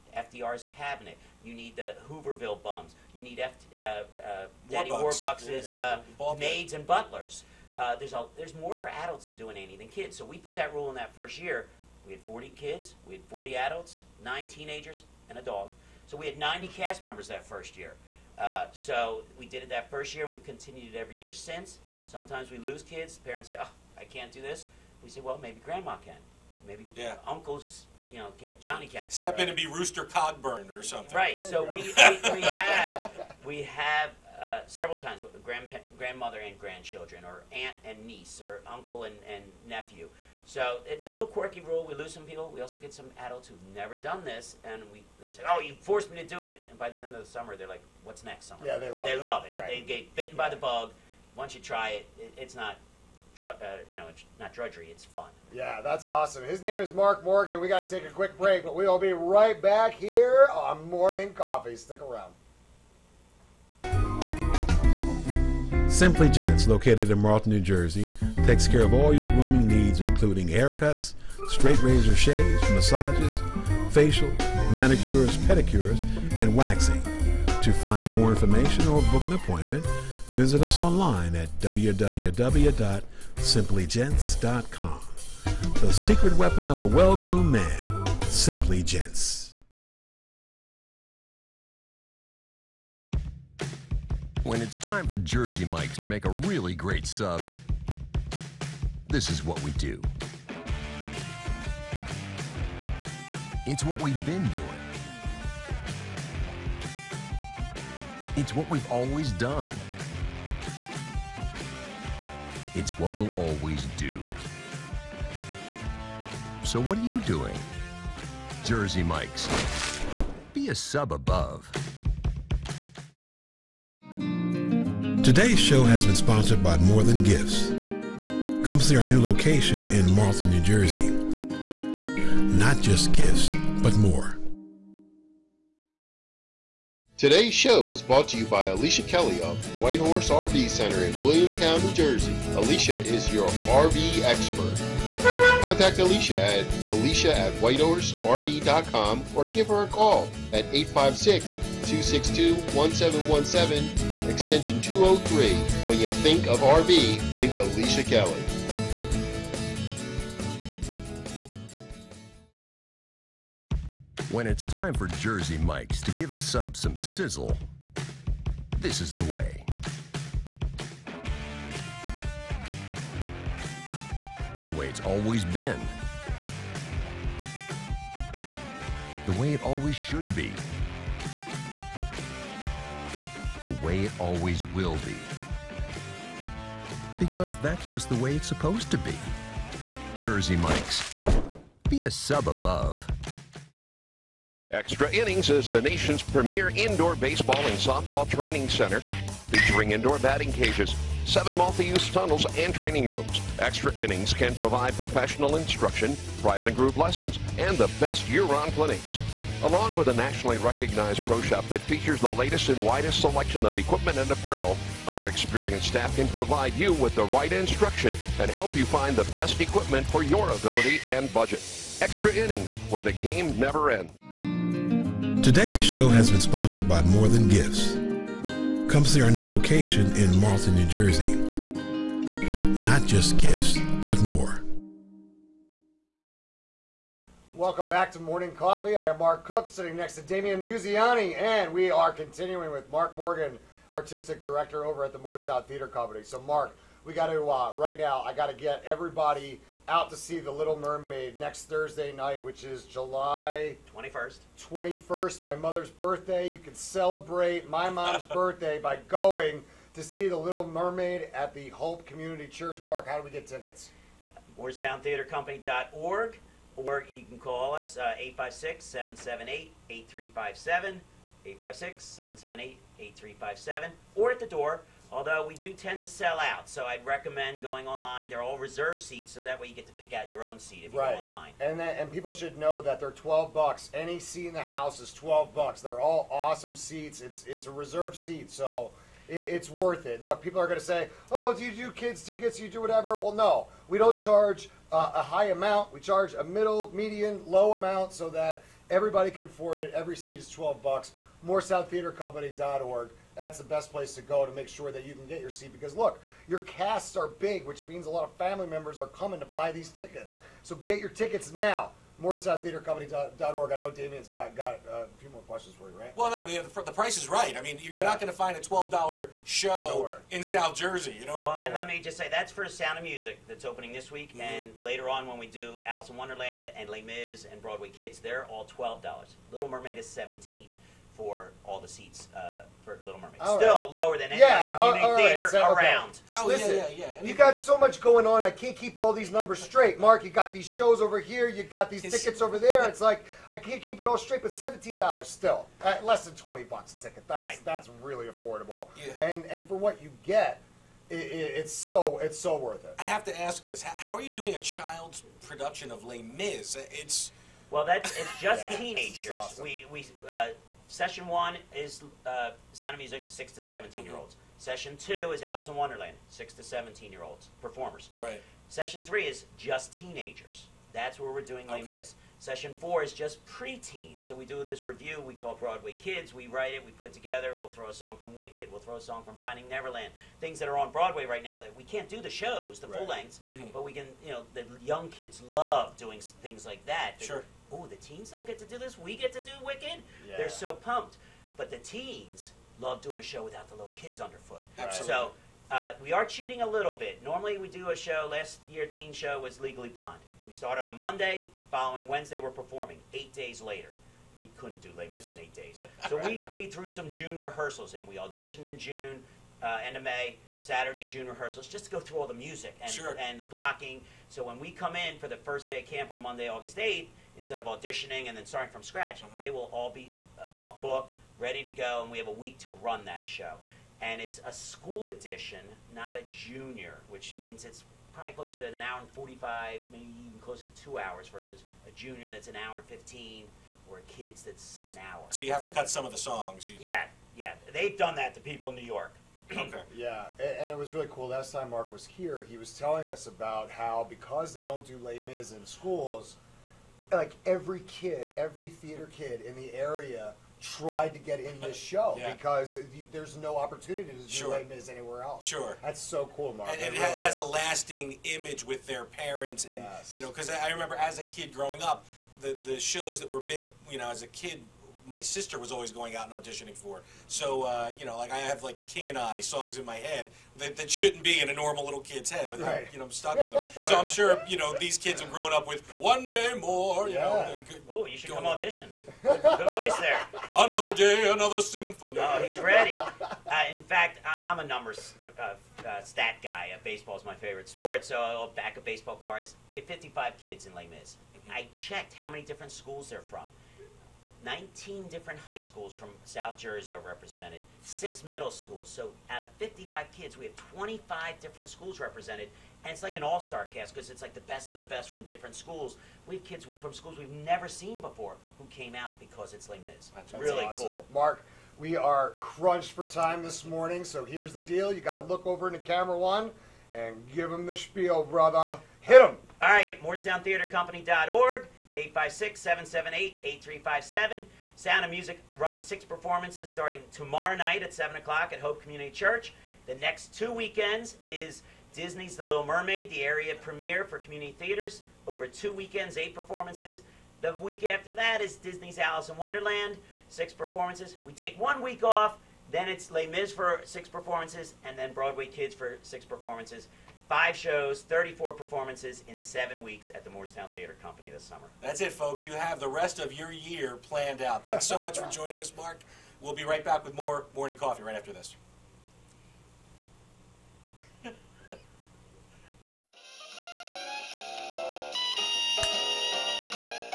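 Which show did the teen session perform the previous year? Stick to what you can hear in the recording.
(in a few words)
Legally Blonde.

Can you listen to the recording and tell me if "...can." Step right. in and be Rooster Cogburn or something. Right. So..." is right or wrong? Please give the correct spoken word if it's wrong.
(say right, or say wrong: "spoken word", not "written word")
right.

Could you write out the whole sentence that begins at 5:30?
dollars for all the seats uh, for Little Mermaid.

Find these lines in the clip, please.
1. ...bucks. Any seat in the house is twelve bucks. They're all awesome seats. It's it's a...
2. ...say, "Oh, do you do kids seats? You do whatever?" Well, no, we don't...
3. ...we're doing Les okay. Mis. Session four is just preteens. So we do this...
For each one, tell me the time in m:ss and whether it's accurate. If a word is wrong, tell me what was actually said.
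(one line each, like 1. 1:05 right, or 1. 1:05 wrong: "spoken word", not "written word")
1. 4:43 right
2. 4:50 wrong: "tickets", not "seats"
3. 6:11 right.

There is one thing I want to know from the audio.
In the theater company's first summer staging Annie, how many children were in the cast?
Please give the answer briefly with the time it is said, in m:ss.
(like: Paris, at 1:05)
40, at 0:12.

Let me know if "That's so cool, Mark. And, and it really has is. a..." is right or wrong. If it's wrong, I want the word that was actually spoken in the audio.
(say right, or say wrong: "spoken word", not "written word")
right.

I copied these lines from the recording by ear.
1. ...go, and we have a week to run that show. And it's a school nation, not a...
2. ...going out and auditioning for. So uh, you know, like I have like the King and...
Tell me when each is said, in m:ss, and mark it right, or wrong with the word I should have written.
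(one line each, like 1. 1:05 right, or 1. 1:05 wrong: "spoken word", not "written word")
1. 7:01 wrong: "edition", not "nation"
2. 7:45 right.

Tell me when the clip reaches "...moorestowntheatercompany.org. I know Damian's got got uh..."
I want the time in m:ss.
5:12.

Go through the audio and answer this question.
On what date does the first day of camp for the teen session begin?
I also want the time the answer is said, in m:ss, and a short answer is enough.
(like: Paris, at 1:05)
Monday, August 8th, at 6:56.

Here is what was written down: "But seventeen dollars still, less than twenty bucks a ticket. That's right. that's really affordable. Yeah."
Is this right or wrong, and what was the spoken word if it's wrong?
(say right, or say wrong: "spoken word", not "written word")
right.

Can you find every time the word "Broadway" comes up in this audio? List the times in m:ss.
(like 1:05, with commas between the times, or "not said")
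5:27, 6:15, 6:20, 9:05.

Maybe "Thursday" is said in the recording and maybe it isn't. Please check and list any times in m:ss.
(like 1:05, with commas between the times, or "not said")
4:11.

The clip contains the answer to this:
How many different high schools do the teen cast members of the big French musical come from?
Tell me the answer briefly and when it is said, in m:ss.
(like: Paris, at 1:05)
19, at 8:14.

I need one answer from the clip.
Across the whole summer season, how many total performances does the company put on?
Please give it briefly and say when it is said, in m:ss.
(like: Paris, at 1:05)
34, at 9:08.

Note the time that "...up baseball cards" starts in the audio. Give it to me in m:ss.
8:08.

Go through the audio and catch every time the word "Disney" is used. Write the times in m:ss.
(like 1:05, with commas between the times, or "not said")
8:51, 8:58.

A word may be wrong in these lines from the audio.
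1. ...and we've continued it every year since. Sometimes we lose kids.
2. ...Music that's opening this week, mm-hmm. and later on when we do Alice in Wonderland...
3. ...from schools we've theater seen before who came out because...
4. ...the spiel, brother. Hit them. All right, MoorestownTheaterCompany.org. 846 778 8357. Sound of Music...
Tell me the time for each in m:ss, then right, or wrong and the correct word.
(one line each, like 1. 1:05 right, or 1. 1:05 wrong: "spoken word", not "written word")
1. 0:20 right
2. 5:23 right
3. 8:26 wrong: "never", not "theater"
4. 8:37 wrong: "856", not "846".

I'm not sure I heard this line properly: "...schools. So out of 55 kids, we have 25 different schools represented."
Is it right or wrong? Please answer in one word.
right.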